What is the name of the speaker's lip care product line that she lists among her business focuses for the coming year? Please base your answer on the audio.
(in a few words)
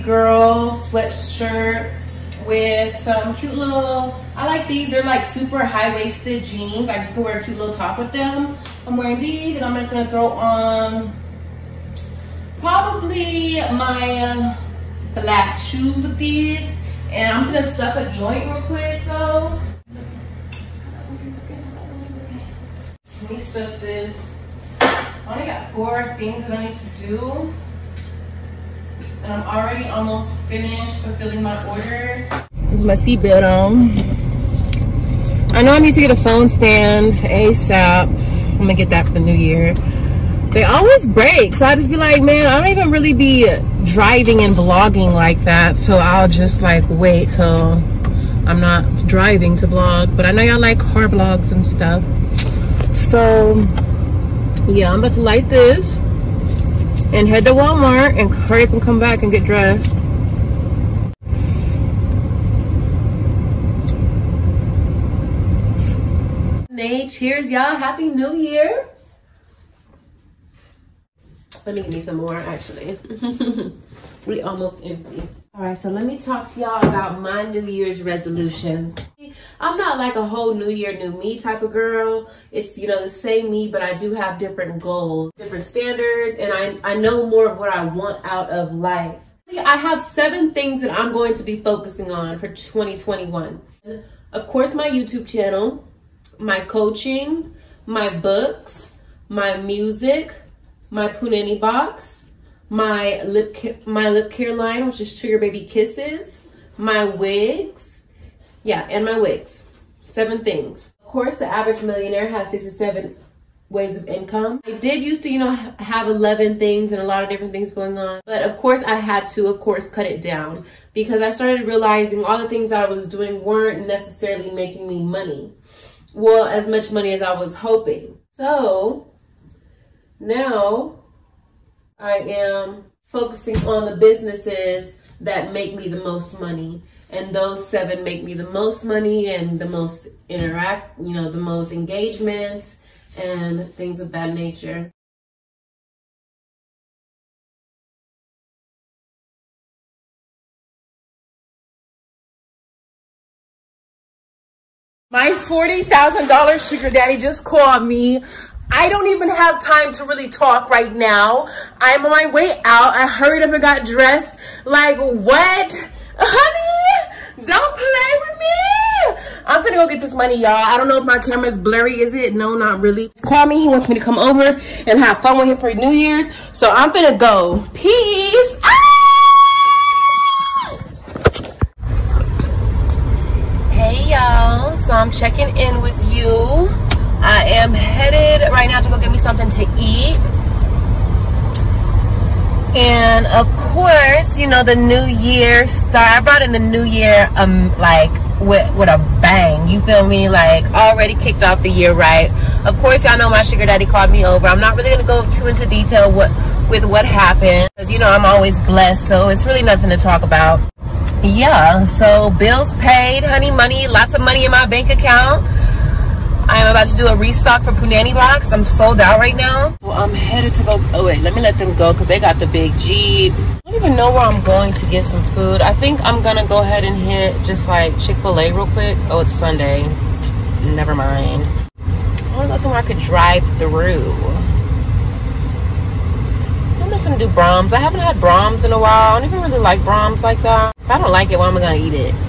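Sugar Baby Kisses.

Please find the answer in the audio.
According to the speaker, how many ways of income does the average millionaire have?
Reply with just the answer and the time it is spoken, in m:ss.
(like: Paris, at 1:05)
67, at 1:52.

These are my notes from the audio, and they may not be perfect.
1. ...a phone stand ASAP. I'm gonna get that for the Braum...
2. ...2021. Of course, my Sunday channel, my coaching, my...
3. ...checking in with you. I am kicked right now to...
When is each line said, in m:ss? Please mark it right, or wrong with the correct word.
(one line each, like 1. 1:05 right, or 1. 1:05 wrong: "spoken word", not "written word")
1. 0:36 wrong: "New", not "Braum"
2. 1:32 wrong: "YouTube", not "Sunday"
3. 3:05 wrong: "headed", not "kicked".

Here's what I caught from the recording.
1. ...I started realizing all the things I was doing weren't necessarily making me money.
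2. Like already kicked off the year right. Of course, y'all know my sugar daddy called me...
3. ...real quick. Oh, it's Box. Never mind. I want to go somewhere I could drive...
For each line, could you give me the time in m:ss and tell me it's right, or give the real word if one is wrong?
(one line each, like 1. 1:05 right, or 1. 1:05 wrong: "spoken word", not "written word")
1. 2:01 right
2. 3:20 right
3. 3:48 wrong: "Sunday", not "Box".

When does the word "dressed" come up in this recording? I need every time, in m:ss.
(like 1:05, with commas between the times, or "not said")
0:59, 2:43.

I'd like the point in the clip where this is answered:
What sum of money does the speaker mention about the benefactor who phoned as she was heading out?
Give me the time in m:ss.
2:35.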